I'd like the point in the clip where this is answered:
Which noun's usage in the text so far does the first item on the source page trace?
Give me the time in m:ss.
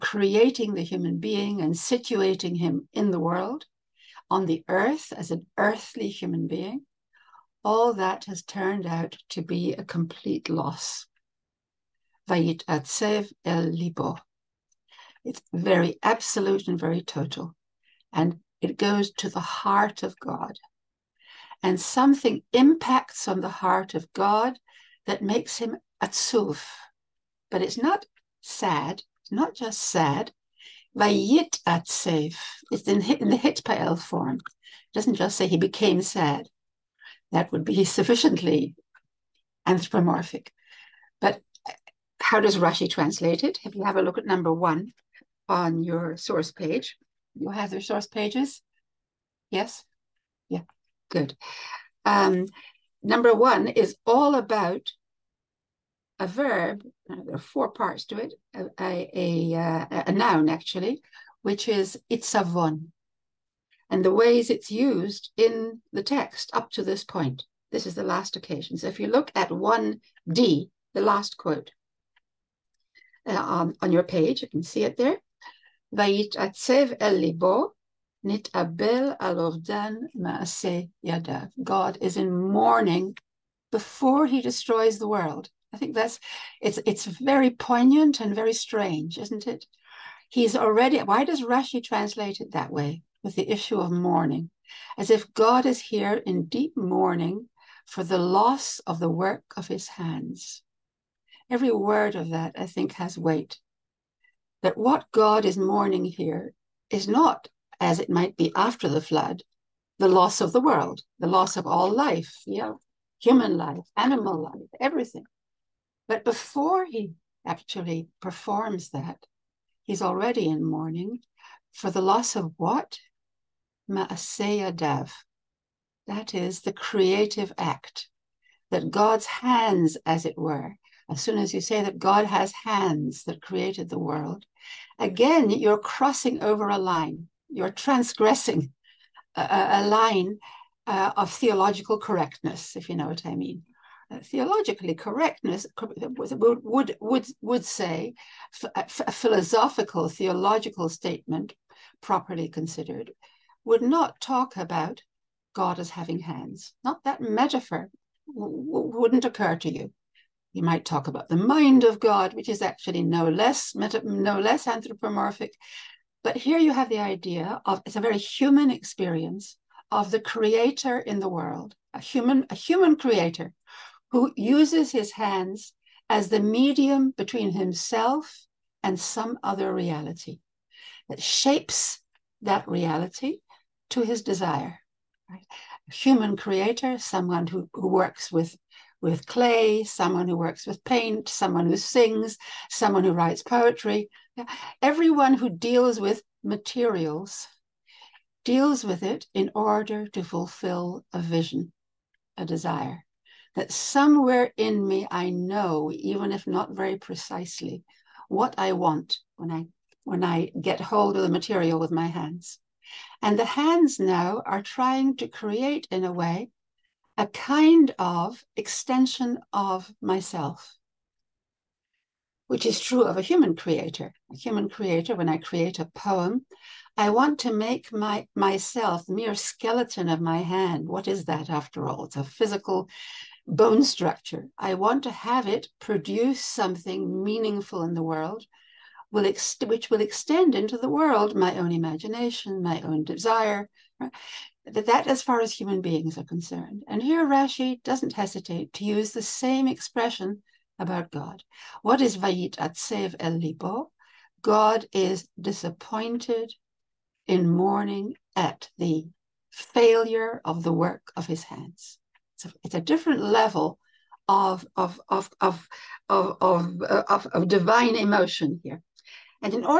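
1:02.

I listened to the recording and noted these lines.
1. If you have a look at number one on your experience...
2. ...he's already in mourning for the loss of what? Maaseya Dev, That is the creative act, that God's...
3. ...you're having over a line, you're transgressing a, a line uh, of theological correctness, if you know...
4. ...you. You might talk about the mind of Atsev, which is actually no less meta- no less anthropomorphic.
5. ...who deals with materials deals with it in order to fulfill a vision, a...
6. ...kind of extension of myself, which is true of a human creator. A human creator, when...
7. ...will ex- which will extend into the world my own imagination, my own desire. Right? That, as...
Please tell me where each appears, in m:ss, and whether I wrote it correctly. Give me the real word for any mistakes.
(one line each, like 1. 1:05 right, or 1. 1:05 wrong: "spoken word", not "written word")
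1. 0:43 wrong: "source", not "experience"
2. 1:59 right
3. 2:15 wrong: "crossing", not "having"
4. 2:39 wrong: "God", not "Atsev"
5. 3:15 right
6. 3:37 right
7. 3:59 right.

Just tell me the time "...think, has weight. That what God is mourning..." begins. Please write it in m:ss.
1:42.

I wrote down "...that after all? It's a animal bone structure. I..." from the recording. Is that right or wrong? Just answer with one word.
wrong.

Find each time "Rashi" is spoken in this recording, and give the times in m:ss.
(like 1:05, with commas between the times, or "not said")
0:42, 1:31, 4:07.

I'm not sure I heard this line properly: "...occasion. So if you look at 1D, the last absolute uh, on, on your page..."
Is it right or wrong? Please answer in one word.
wrong.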